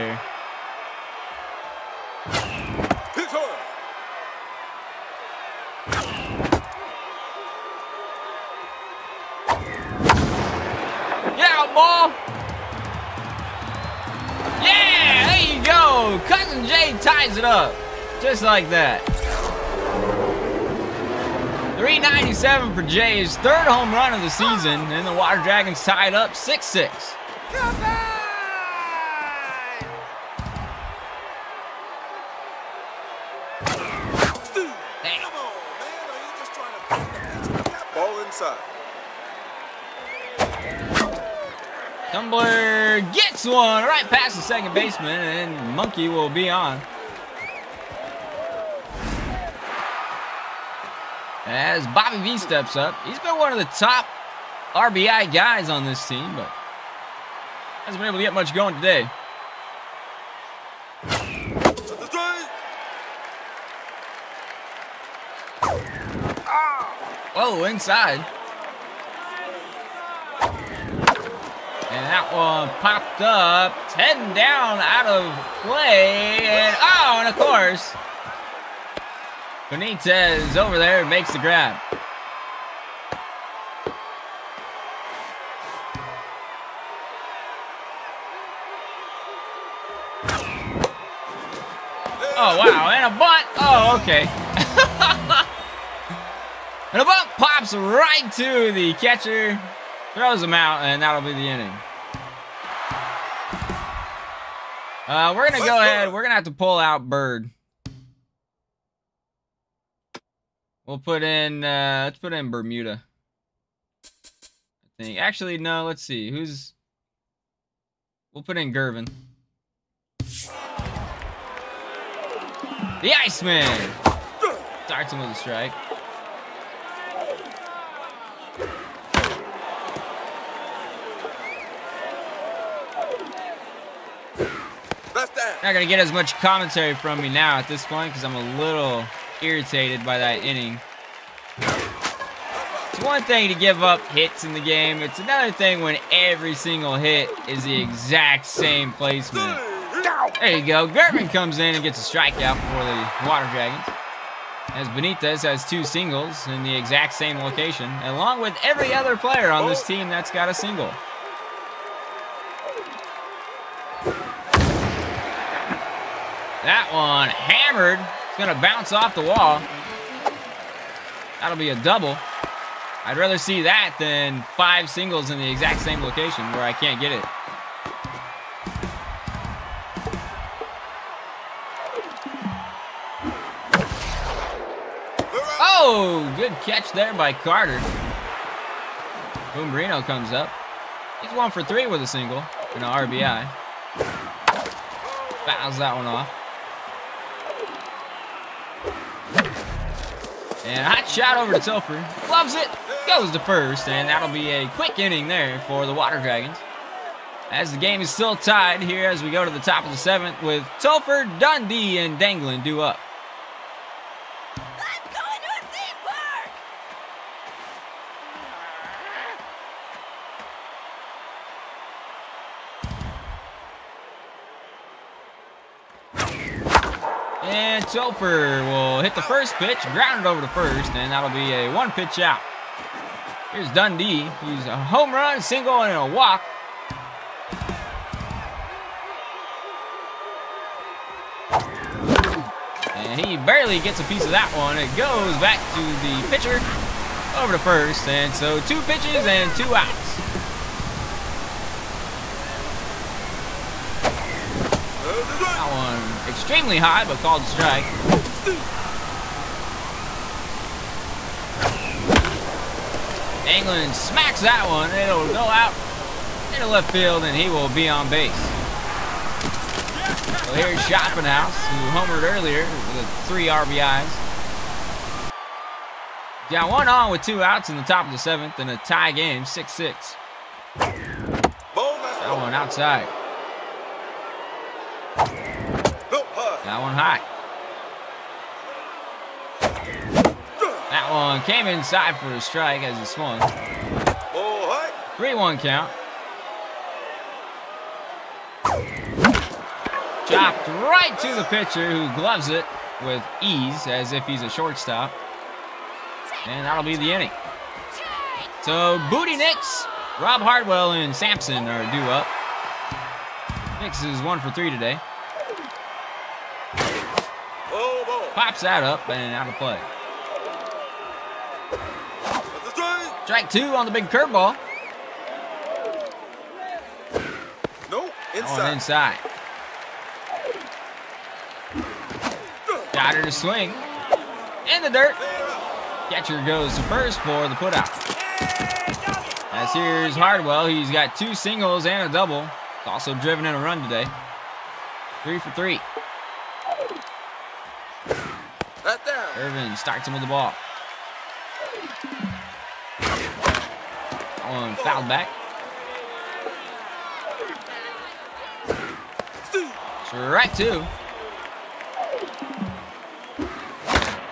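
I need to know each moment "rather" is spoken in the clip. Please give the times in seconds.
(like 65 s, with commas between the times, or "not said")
173 s.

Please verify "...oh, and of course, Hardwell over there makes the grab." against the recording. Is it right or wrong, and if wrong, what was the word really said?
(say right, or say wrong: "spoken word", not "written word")
wrong: "Benitez", not "Hardwell".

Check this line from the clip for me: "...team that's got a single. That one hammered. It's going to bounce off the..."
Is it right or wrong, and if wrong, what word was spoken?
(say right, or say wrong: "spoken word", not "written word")
right.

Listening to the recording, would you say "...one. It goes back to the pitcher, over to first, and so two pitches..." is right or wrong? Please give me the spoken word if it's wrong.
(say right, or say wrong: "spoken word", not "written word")
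right.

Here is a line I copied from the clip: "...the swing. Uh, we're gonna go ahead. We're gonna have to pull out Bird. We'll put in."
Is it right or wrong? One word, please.
wrong.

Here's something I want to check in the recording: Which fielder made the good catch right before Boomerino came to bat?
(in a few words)
Carter.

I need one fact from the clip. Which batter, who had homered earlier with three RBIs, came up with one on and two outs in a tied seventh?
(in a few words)
Schaffenhaus.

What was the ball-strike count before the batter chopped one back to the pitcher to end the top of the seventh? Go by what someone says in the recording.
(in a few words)
3-1.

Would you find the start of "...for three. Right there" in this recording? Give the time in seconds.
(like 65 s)
345 s.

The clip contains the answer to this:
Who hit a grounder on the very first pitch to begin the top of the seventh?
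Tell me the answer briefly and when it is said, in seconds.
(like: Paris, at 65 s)
Aaron Telfer, at 227 s.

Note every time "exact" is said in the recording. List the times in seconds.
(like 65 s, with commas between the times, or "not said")
147 s, 156 s, 175 s.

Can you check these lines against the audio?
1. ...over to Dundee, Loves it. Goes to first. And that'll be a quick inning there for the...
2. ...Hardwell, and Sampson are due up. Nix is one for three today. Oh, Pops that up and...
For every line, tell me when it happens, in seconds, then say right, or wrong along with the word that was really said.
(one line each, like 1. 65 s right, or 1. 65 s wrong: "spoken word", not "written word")
1. 201 s wrong: "Telfer", not "Dundee"
2. 310 s right.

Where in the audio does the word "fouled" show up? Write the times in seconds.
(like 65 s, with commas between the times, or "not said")
354 s.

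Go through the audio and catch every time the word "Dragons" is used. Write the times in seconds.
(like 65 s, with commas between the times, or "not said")
25 s, 153 s, 206 s.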